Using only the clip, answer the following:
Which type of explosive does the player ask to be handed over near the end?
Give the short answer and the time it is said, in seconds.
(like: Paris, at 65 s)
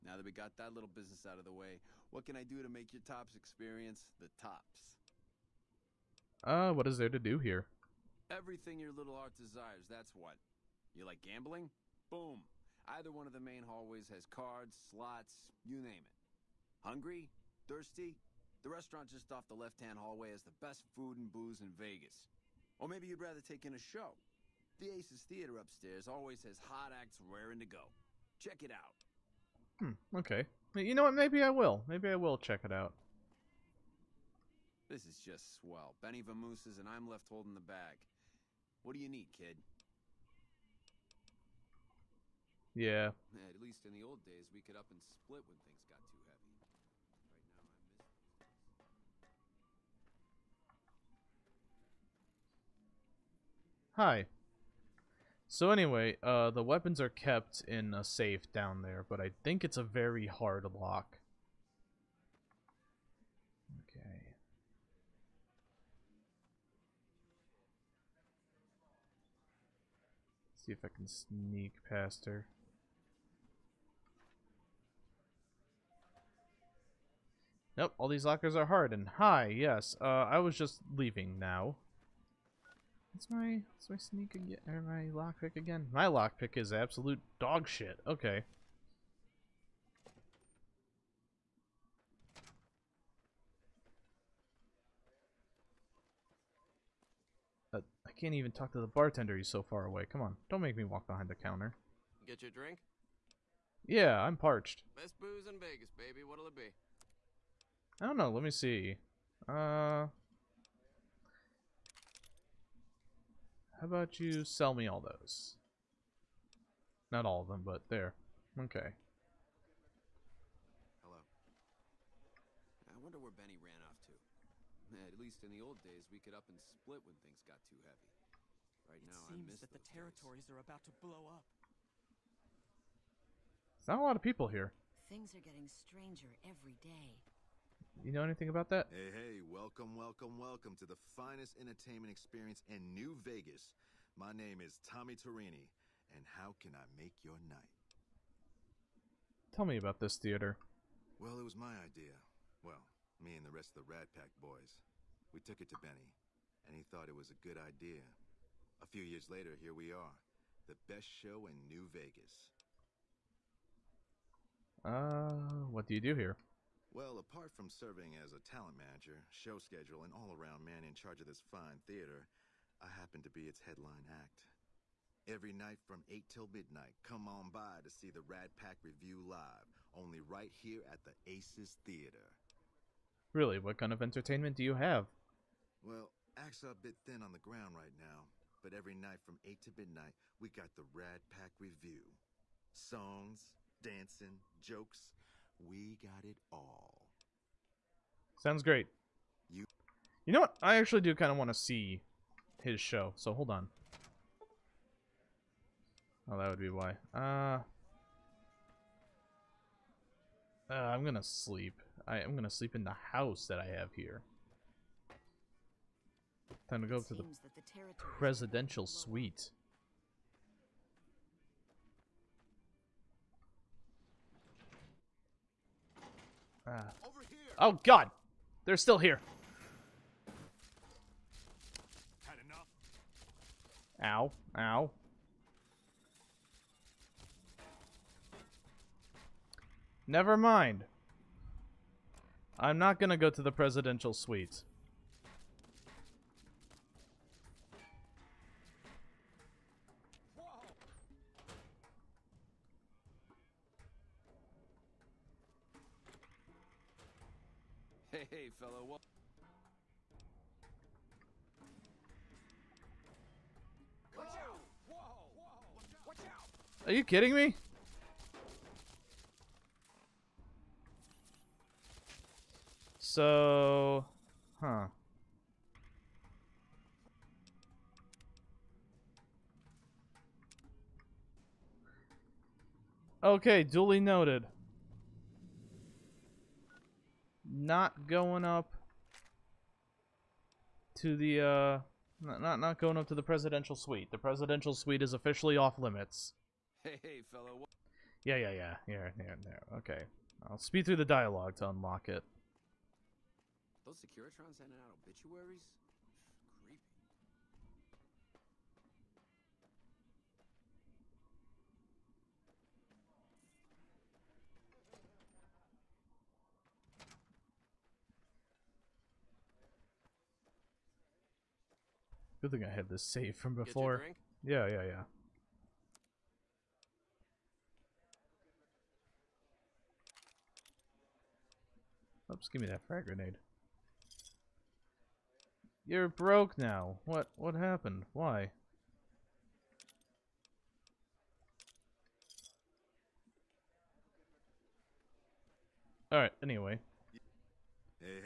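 frag grenade, at 332 s.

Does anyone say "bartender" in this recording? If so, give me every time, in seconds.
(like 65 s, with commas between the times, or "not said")
98 s.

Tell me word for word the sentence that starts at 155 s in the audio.
We took it to Benny, and he thought it was a good idea.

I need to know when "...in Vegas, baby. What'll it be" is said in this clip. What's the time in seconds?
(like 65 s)
105 s.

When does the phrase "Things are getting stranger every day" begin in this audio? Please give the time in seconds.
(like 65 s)
135 s.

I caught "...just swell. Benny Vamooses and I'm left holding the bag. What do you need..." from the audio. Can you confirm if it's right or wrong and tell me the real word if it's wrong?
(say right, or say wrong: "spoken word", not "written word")
right.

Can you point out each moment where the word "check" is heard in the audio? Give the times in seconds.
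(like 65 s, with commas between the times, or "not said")
28 s, 32 s.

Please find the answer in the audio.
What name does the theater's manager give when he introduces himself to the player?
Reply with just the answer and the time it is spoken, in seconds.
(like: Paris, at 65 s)
Tommy Torini, at 144 s.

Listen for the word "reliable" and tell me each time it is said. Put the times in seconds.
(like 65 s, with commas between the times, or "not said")
not said.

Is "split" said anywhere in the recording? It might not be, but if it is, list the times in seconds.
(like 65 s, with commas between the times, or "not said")
45 s, 126 s.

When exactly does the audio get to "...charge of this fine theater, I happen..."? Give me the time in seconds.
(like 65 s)
170 s.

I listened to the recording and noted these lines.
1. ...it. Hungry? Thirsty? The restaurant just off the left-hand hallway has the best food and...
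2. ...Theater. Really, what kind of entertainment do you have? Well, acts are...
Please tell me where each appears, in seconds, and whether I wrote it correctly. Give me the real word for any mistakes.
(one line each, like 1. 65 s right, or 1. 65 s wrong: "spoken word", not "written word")
1. 16 s right
2. 181 s right.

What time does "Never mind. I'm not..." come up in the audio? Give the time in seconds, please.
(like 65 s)
240 s.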